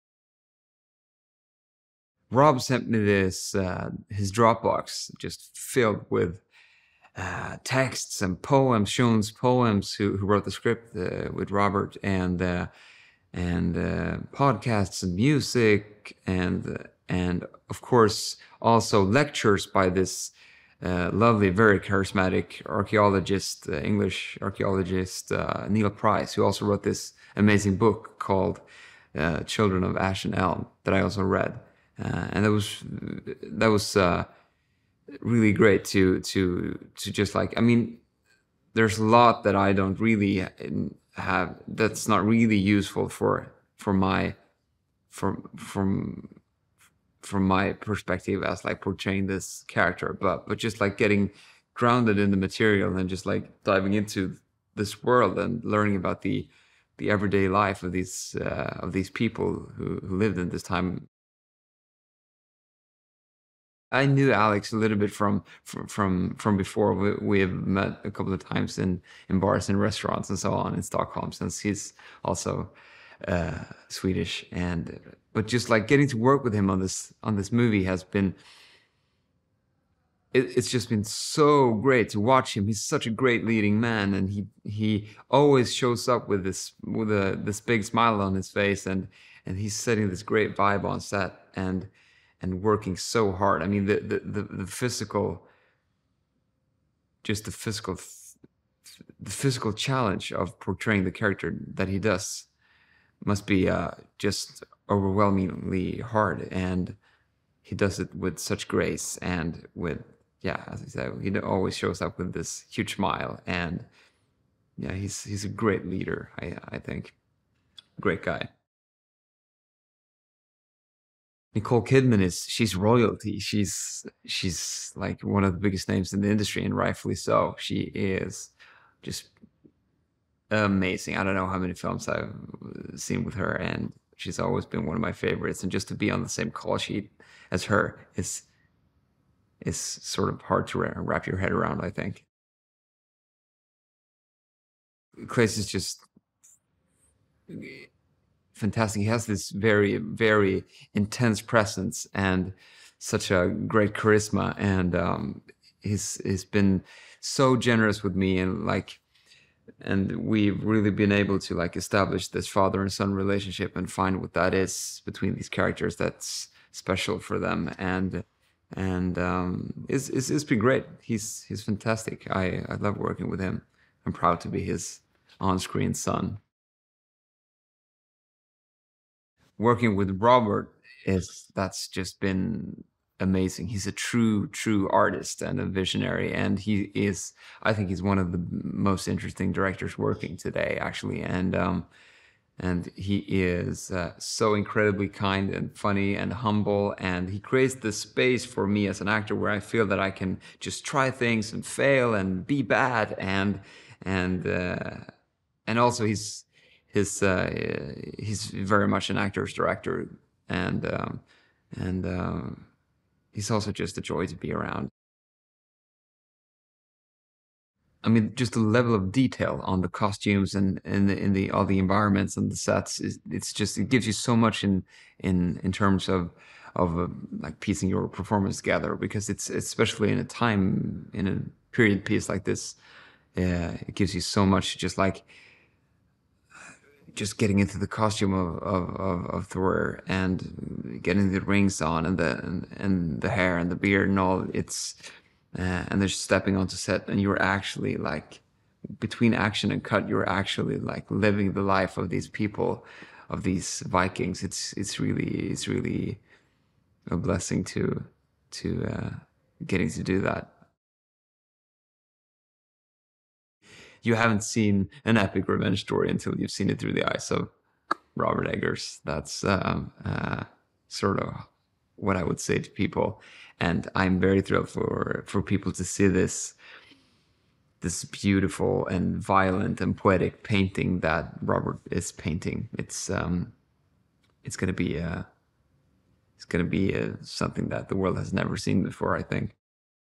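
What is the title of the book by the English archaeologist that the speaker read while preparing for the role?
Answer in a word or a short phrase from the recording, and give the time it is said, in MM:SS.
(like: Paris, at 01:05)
Children of Ash and Elm, at 00:29.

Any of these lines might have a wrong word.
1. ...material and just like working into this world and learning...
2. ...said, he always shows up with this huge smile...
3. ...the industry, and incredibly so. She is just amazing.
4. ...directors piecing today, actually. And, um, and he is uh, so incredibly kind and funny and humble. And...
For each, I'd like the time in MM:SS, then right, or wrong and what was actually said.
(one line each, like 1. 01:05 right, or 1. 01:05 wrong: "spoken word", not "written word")
1. 00:52 wrong: "diving", not "working"
2. 01:50 right
3. 02:06 wrong: "rightfully", not "incredibly"
4. 03:09 wrong: "working", not "piecing".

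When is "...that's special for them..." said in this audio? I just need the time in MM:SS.
02:45.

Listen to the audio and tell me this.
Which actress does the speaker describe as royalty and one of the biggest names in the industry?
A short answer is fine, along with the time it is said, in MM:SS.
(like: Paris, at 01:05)
Nicole Kidman, at 02:01.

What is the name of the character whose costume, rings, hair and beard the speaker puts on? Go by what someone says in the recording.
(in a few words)
Thor.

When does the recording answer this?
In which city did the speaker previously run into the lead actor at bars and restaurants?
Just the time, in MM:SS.
01:10.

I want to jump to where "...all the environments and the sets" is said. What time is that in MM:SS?
03:41.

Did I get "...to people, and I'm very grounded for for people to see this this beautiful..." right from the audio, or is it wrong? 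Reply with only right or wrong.
wrong.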